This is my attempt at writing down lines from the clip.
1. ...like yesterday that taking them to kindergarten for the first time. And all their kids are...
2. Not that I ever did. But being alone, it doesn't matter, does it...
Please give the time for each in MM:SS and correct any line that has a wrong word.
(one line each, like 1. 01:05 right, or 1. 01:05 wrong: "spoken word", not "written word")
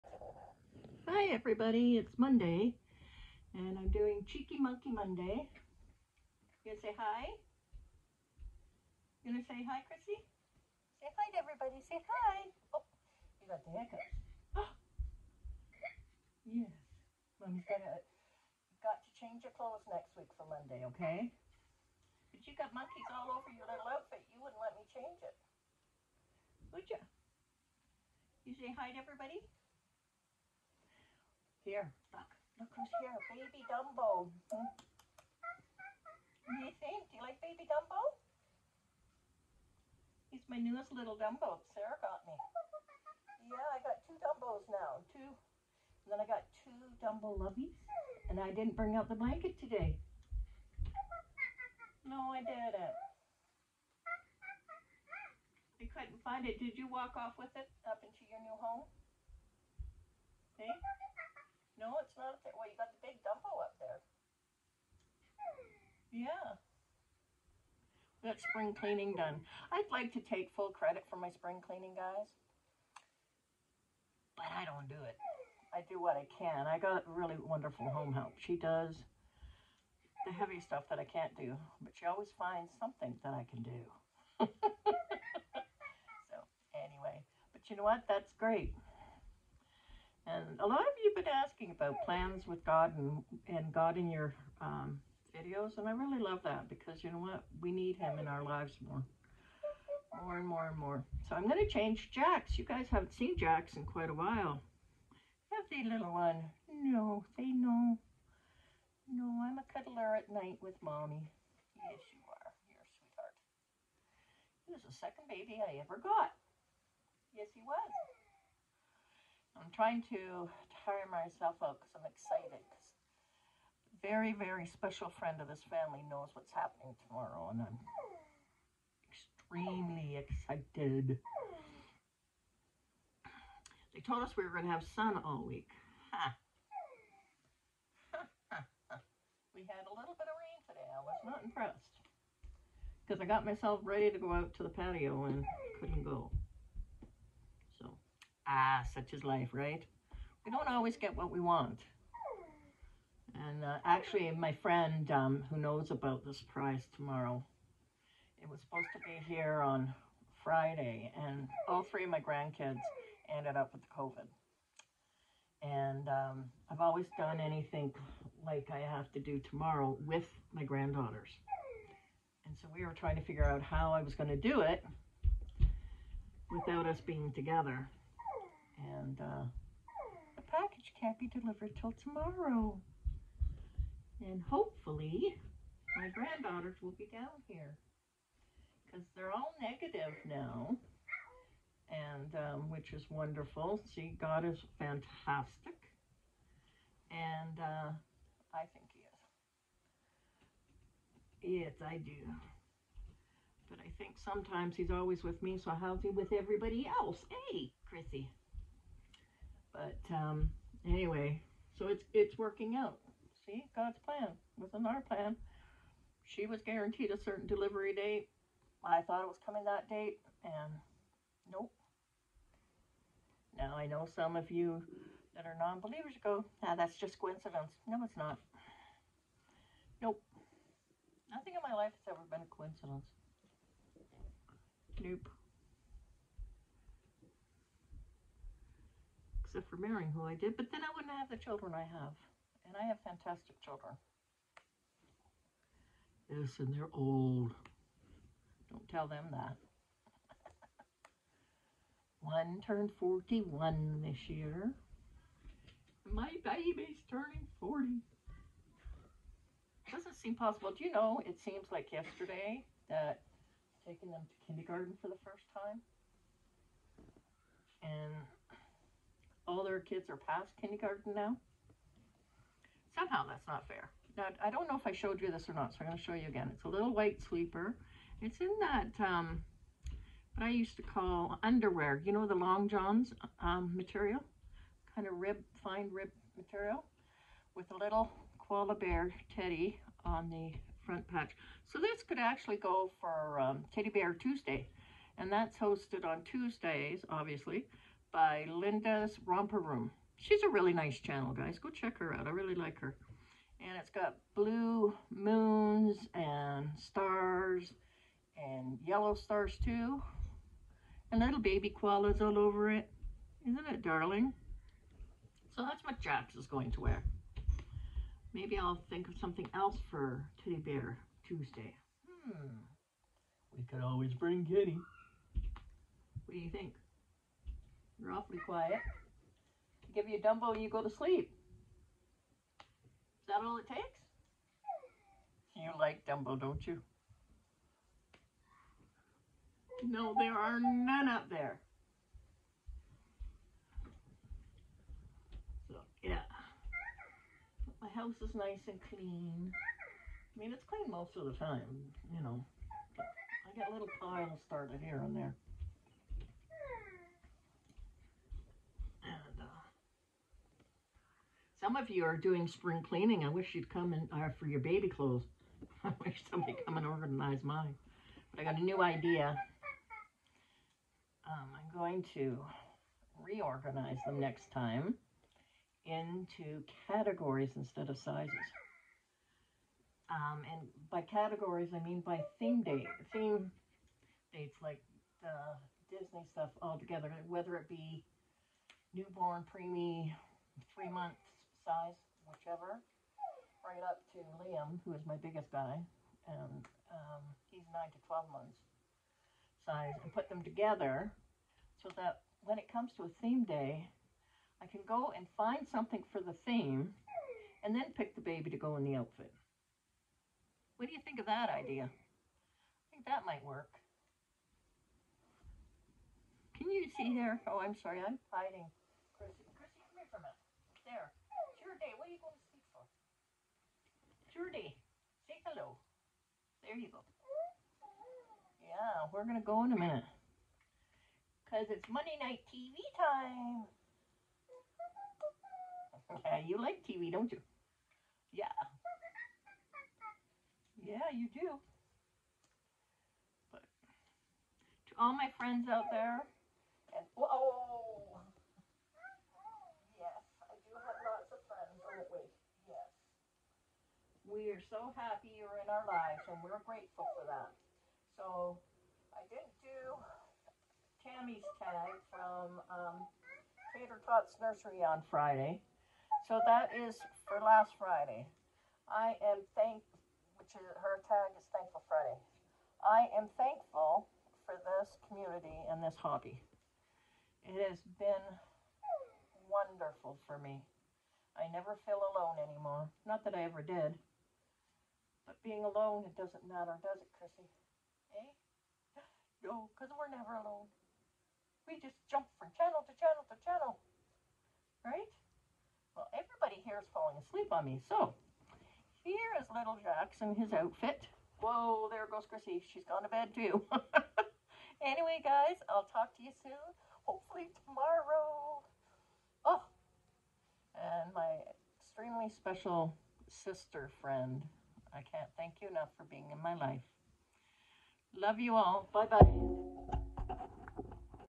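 1. 04:21 right
2. 08:03 right.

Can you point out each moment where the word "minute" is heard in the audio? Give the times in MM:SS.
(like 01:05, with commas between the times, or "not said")
07:00, 07:09.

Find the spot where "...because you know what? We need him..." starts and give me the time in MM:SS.
01:36.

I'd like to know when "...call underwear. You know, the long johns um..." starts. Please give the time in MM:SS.
04:40.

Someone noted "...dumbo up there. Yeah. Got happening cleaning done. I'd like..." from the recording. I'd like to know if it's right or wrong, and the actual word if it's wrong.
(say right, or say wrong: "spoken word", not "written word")
wrong: "spring", not "happening".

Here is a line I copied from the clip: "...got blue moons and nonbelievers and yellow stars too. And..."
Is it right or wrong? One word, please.
wrong.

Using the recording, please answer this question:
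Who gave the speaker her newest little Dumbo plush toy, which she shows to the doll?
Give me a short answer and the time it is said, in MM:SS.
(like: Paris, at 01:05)
Sarah, at 00:41.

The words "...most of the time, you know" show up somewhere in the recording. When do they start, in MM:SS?
05:50.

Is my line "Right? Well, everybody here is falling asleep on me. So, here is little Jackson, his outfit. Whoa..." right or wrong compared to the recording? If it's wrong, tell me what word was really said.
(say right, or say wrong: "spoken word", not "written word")
right.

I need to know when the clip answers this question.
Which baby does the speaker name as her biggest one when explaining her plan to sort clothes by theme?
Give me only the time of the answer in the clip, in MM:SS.
06:34.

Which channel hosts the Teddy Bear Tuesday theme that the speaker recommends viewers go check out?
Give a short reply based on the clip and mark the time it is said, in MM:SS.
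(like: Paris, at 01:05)
Linda's Romper Room, at 04:58.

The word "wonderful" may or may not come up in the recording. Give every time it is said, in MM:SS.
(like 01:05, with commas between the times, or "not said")
01:17, 03:13, 07:59.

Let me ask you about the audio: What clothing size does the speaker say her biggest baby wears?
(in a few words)
9 to 12 months.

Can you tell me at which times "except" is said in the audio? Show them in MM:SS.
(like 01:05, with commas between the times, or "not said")
03:59.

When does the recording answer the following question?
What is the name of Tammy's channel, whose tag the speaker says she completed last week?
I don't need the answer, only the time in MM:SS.
07:43.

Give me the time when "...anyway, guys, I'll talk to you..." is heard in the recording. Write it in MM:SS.
08:24.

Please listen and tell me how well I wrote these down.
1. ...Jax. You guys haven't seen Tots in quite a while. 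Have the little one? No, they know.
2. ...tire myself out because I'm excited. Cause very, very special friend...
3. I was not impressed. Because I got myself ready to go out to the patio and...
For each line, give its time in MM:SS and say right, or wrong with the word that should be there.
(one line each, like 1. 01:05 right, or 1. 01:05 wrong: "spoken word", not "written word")
1. 01:42 wrong: "Jax", not "Tots"
2. 02:00 right
3. 02:20 right.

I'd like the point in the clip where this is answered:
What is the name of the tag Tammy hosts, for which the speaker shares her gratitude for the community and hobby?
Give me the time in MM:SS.
07:51.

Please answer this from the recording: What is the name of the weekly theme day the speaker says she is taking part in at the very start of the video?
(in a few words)
Cheeky Monkey Monday.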